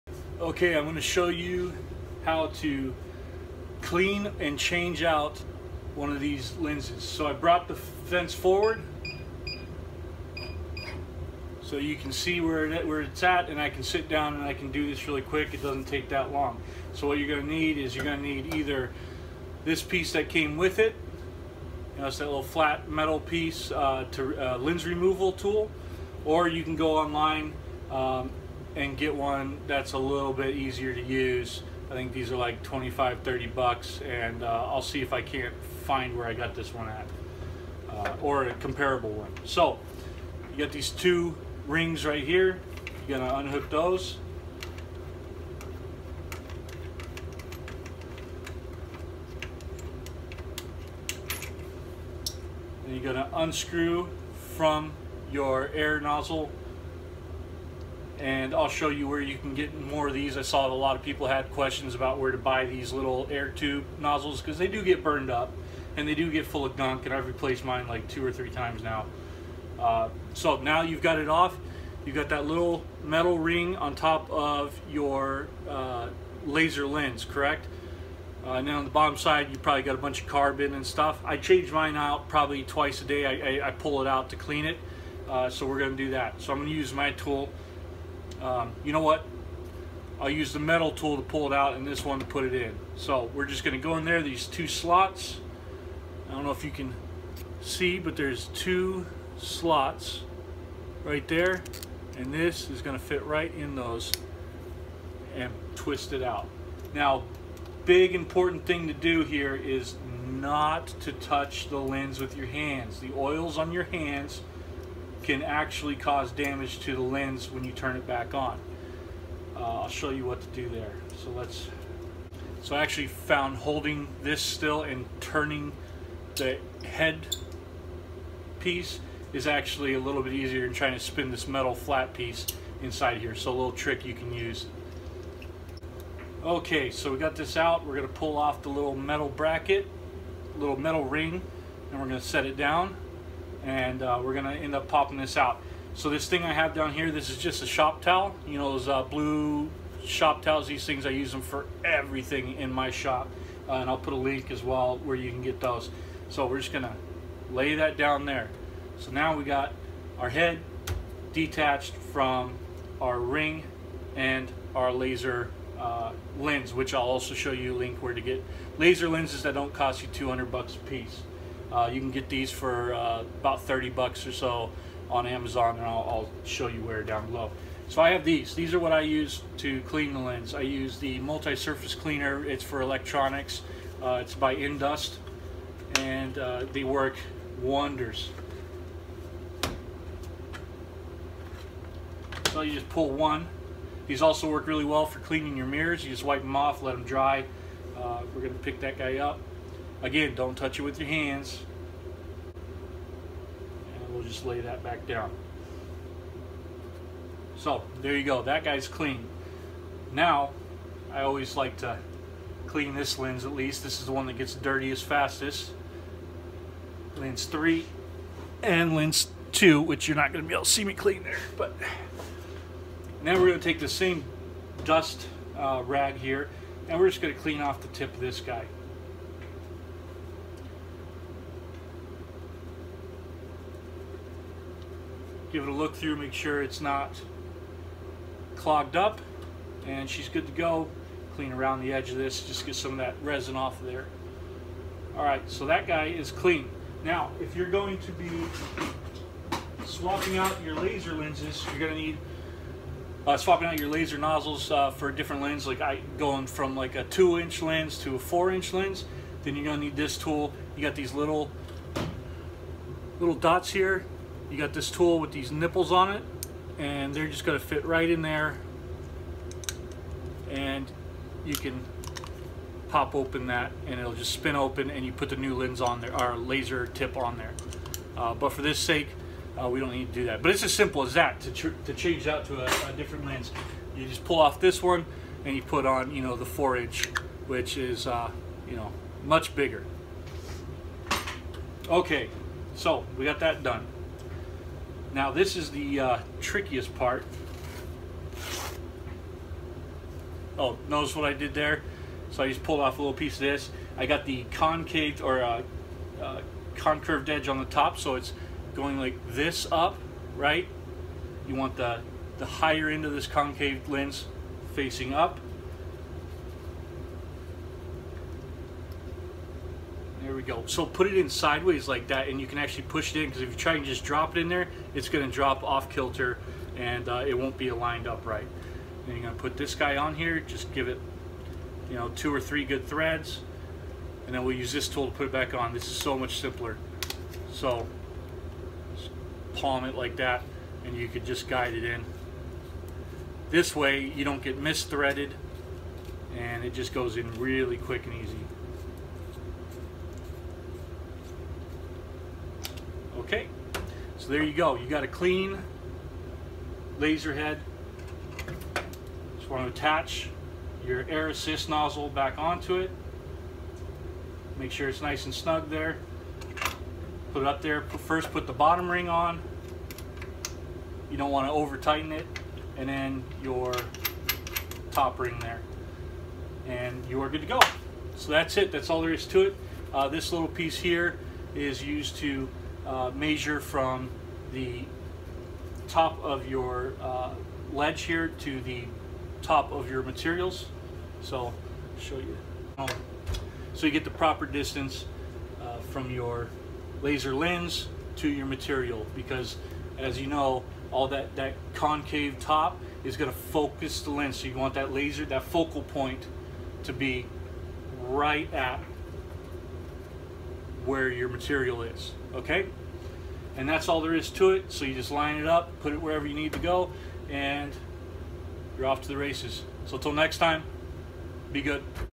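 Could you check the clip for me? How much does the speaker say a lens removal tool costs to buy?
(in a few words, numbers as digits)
25 to 30 dollars.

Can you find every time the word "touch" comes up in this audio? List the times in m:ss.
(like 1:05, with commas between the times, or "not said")
1:51, 3:20.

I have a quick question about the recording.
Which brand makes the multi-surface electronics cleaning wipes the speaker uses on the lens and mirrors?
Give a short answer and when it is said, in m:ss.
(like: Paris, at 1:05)
Endust, at 3:04.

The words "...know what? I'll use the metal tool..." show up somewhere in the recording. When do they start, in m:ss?
1:28.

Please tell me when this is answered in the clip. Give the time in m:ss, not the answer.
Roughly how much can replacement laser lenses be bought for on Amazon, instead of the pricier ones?
2:53.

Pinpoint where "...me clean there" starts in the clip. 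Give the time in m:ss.
3:40.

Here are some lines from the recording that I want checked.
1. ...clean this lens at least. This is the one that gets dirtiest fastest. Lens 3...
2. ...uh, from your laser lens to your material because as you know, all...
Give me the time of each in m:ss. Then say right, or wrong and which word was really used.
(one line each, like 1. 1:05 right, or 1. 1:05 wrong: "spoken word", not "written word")
1. 3:32 right
2. 6:35 right.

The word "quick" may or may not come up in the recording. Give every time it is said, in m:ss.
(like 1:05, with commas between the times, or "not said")
0:15, 5:47.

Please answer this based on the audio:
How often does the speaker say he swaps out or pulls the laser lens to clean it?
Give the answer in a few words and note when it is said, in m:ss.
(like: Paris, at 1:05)
Twice a day, at 1:22.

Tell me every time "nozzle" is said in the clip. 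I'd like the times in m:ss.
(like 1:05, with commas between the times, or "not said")
0:55, 1:03, 4:14, 6:01.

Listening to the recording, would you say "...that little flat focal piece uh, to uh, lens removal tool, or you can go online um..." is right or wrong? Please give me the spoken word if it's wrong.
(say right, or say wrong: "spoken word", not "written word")
wrong: "metal", not "focal".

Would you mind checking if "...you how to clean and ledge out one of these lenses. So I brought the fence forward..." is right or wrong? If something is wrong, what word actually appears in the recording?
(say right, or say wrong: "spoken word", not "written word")
wrong: "change", not "ledge".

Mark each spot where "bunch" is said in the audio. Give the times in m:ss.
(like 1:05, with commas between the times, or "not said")
1:19.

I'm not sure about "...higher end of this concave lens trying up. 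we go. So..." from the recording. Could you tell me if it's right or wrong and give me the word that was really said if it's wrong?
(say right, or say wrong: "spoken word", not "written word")
wrong: "facing", not "trying".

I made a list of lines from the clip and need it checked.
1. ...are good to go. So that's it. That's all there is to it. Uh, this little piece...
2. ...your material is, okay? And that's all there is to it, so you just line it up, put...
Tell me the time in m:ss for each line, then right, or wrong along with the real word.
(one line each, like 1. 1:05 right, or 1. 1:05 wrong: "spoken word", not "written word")
1. 6:17 right
2. 6:51 right.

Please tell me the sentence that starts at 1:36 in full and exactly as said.
I don't know if you can see, but there's two slots right there.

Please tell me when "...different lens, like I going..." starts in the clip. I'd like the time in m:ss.
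4:15.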